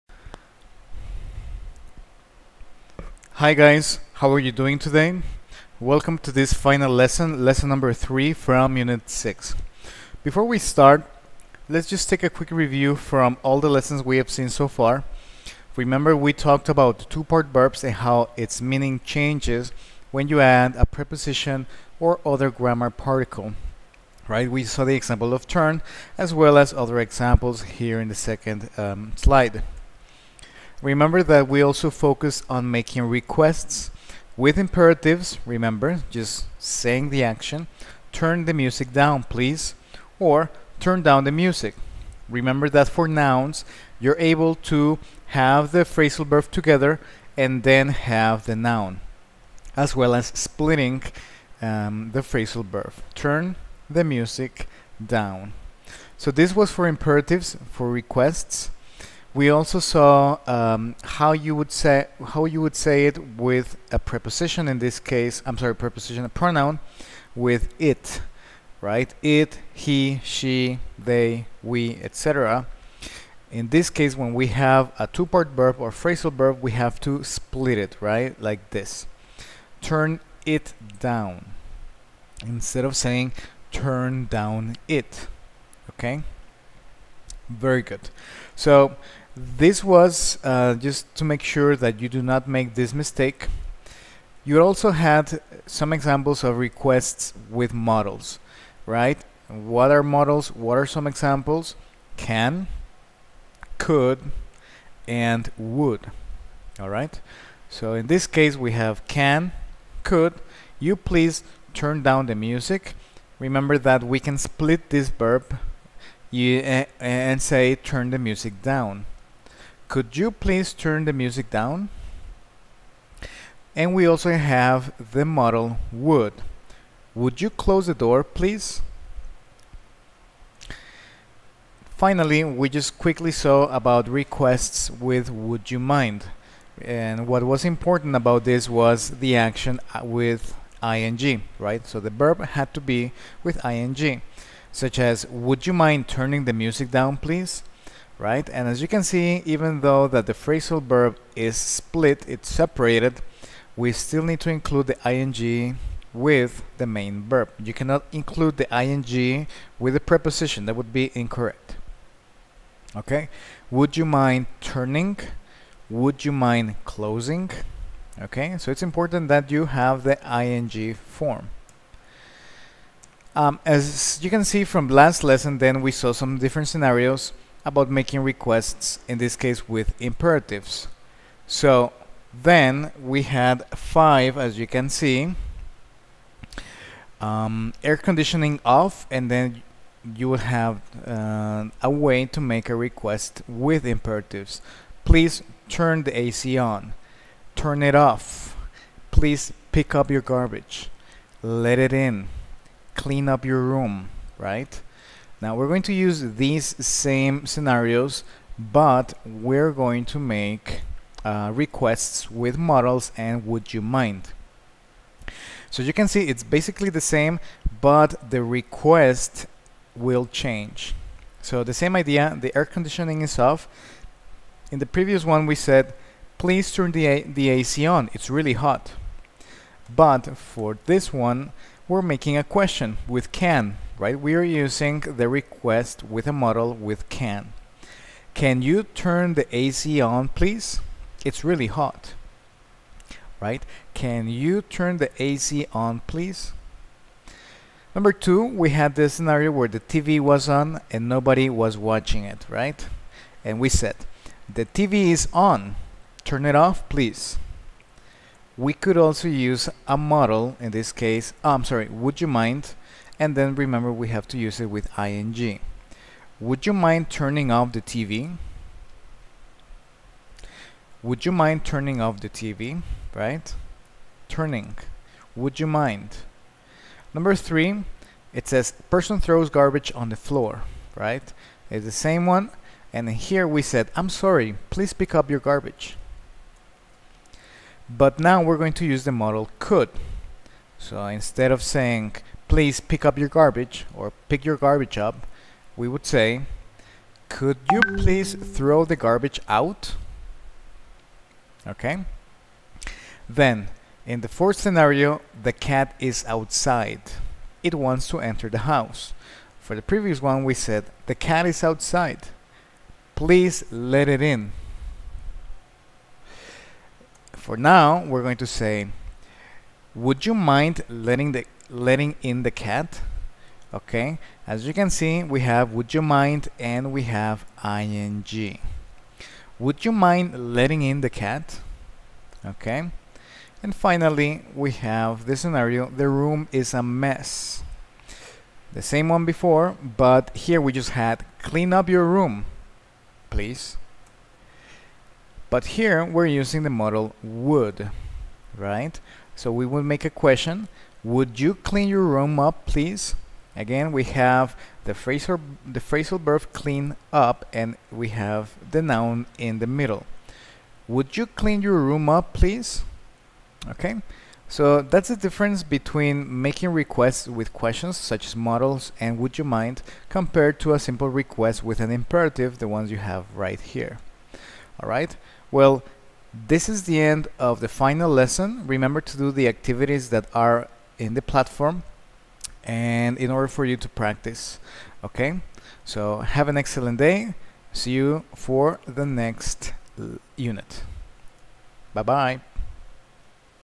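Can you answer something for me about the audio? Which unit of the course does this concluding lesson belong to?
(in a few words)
Unit 6.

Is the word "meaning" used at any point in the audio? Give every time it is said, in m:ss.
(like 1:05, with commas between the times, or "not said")
0:18.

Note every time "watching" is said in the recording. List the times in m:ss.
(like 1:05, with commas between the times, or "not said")
4:11.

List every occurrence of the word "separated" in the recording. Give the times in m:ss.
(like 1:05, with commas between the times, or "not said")
2:32.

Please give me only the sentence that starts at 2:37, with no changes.
You cannot include the ing with the preposition.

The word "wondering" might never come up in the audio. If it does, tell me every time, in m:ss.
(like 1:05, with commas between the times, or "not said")
not said.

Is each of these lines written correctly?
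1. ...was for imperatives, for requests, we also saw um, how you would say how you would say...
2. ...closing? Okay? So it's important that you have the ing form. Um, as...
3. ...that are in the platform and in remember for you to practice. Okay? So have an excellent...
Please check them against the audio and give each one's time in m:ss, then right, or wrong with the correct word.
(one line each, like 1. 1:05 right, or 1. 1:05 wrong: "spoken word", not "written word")
1. 0:56 right
2. 2:46 right
3. 6:20 wrong: "order", not "remember".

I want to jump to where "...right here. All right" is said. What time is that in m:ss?
6:13.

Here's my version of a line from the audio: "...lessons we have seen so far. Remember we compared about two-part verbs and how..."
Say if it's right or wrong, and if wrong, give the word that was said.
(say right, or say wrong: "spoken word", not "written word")
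wrong: "talked", not "compared".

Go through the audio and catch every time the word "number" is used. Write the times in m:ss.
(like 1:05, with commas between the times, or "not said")
0:07, 4:07, 4:37.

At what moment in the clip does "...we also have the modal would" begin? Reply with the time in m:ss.
2:03.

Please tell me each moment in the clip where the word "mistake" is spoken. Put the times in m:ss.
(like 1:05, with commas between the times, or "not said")
1:32.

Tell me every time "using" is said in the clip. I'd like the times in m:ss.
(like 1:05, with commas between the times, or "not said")
3:54, 5:46.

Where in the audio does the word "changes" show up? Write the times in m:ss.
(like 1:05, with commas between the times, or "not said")
0:19, 3:40.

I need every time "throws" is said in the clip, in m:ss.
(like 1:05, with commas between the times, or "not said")
4:39, 4:58.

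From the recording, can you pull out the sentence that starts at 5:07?
It wants to enter the house.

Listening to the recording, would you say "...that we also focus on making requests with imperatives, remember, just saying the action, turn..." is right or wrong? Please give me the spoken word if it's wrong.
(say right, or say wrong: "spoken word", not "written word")
right.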